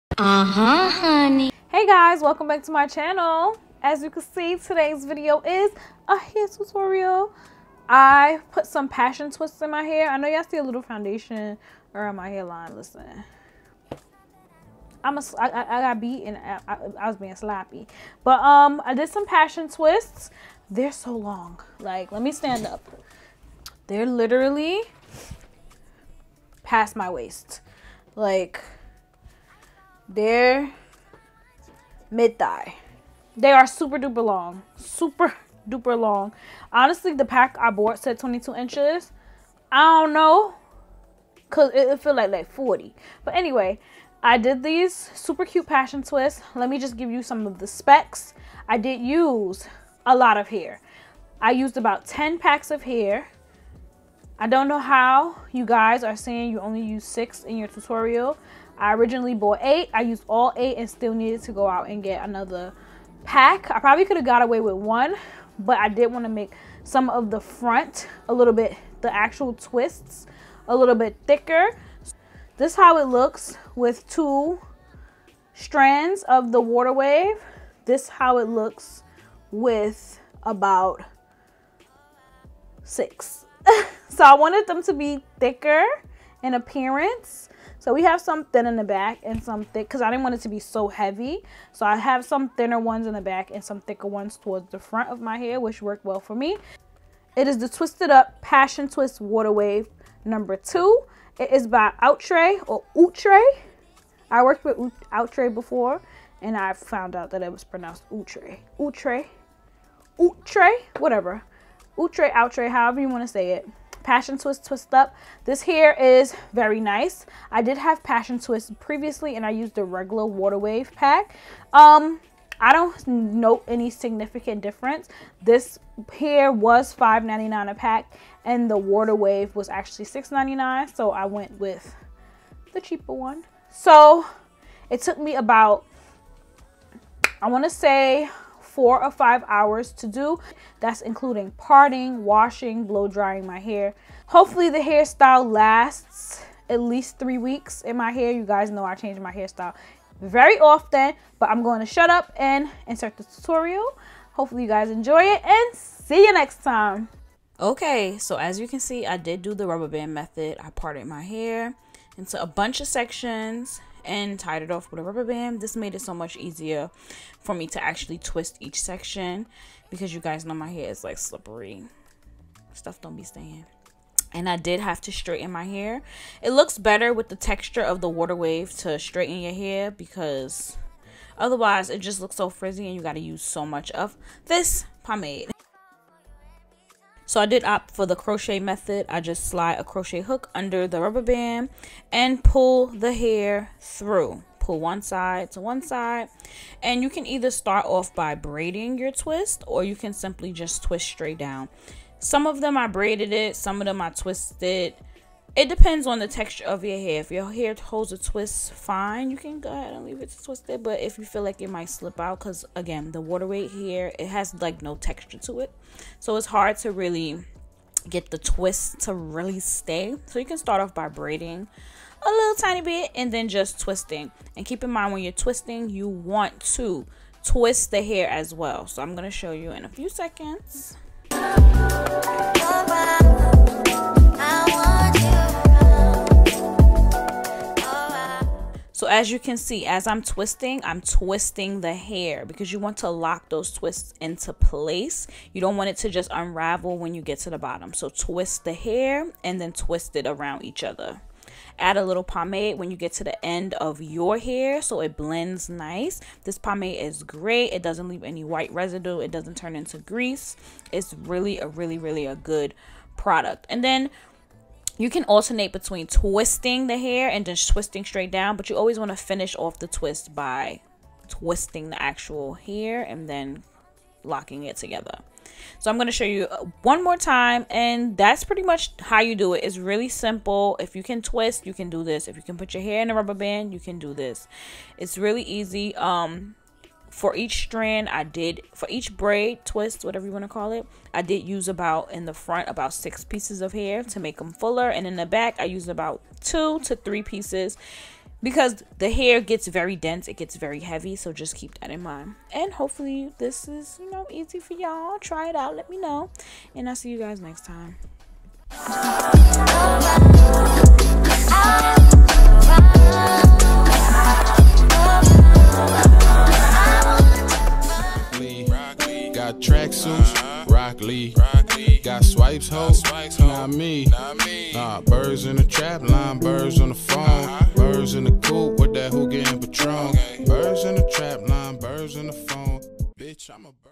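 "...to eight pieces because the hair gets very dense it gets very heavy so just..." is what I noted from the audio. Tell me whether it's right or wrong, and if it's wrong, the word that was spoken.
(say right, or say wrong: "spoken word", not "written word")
wrong: "three", not "eight".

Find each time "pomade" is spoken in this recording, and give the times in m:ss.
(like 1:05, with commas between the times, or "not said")
3:05, 4:12, 4:16.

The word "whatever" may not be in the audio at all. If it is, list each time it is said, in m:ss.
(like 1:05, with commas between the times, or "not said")
1:50, 4:50.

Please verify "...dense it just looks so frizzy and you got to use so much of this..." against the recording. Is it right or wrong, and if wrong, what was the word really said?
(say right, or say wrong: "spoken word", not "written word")
wrong: "otherwise", not "dense".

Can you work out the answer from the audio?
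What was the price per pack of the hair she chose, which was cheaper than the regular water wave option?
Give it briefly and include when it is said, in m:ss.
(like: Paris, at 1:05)
$5.99, at 2:06.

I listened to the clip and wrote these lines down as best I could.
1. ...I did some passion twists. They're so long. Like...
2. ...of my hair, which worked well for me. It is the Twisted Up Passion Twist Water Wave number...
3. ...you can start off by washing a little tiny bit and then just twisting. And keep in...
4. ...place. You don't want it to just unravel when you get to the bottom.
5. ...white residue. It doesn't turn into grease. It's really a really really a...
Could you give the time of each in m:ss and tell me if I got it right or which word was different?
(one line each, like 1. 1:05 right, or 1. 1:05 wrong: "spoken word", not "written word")
1. 0:18 right
2. 1:35 right
3. 3:40 wrong: "braiding", not "washing"
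4. 4:04 right
5. 4:18 right.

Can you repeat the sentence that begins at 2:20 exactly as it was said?
That's including parting, washing, blow drying my hair.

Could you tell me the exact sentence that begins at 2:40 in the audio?
I parted my hair into a bunch of sections and tied it off with a rubber band.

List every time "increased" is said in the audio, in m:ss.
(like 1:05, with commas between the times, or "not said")
not said.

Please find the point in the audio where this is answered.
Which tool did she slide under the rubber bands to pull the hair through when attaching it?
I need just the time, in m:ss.
3:09.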